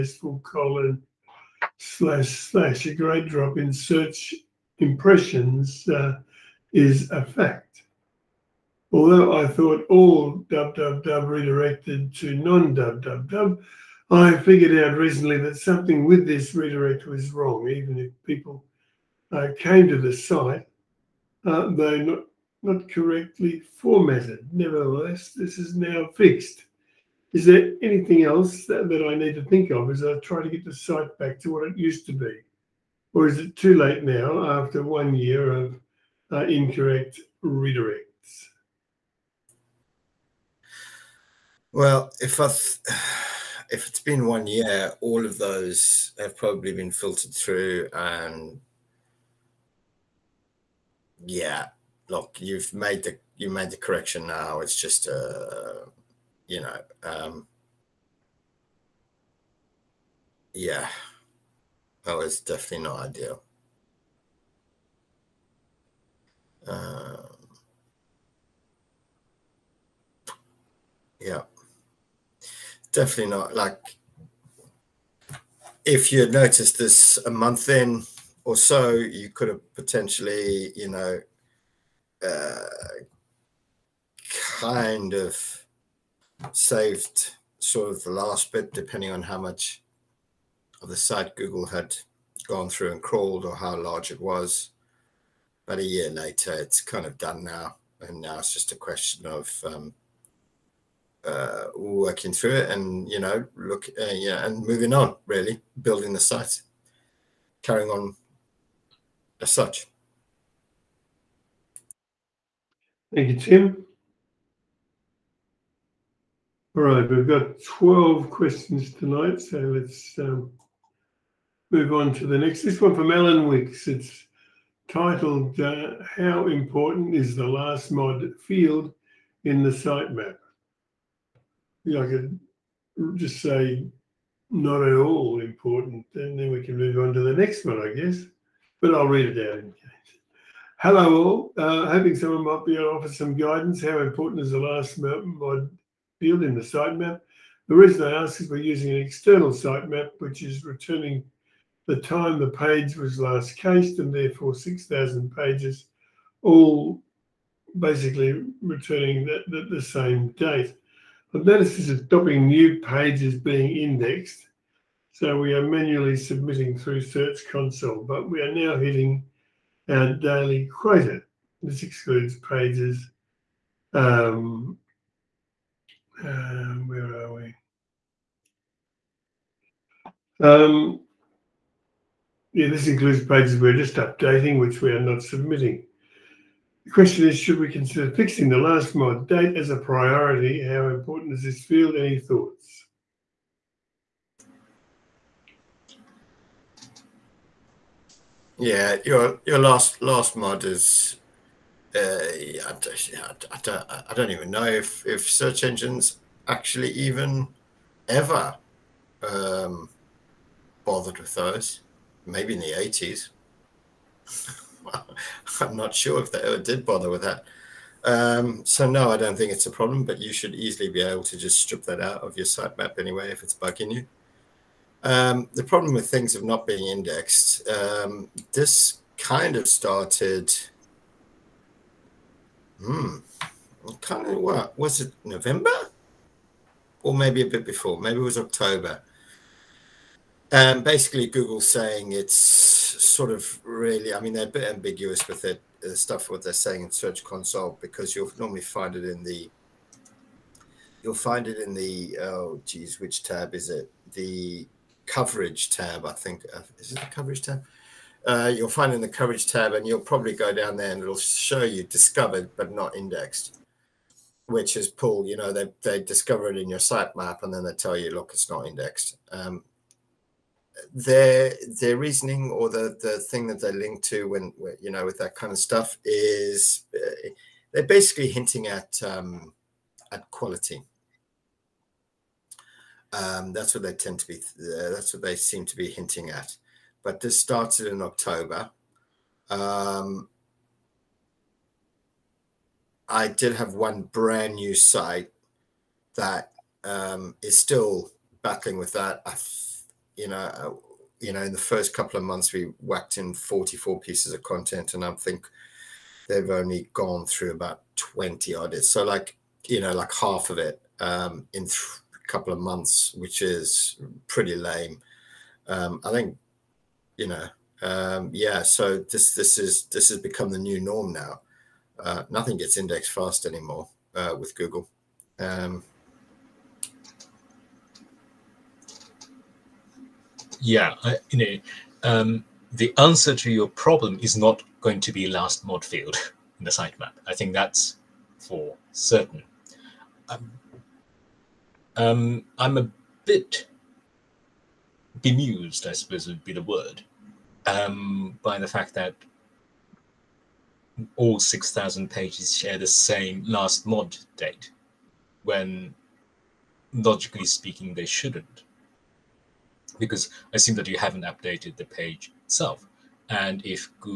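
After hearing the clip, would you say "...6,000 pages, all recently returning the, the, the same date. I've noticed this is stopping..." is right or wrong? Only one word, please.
wrong.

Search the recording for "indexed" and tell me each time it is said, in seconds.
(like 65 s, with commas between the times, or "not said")
163 s, 226 s, 262 s, 268 s, 322 s.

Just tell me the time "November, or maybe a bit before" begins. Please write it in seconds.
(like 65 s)
235 s.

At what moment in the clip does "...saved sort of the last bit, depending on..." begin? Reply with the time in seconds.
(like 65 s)
86 s.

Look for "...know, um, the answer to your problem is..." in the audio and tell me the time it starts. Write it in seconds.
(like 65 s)
331 s.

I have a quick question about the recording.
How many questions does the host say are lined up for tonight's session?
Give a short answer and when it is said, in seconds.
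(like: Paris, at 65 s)
12, at 117 s.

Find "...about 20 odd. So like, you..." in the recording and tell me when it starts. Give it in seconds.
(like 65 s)
307 s.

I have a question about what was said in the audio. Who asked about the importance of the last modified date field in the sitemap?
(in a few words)
Alan Wicks.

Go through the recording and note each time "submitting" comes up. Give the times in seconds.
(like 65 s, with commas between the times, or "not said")
166 s, 185 s.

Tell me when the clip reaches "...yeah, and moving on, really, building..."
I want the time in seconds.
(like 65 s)
104 s.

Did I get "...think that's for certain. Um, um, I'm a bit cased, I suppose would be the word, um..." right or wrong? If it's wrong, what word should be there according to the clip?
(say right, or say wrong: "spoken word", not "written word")
wrong: "bemused", not "cased".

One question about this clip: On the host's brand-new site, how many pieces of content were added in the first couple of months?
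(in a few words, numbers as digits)
44.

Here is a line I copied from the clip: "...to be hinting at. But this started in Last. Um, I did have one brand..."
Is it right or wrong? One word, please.
wrong.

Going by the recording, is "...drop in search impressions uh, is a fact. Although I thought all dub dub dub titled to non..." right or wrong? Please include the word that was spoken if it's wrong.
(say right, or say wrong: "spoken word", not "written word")
wrong: "redirected", not "titled".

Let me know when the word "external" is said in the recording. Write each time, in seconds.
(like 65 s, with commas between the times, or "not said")
149 s.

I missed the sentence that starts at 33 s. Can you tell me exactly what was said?
Or is it too late now after one year of uh, incorrect redirects?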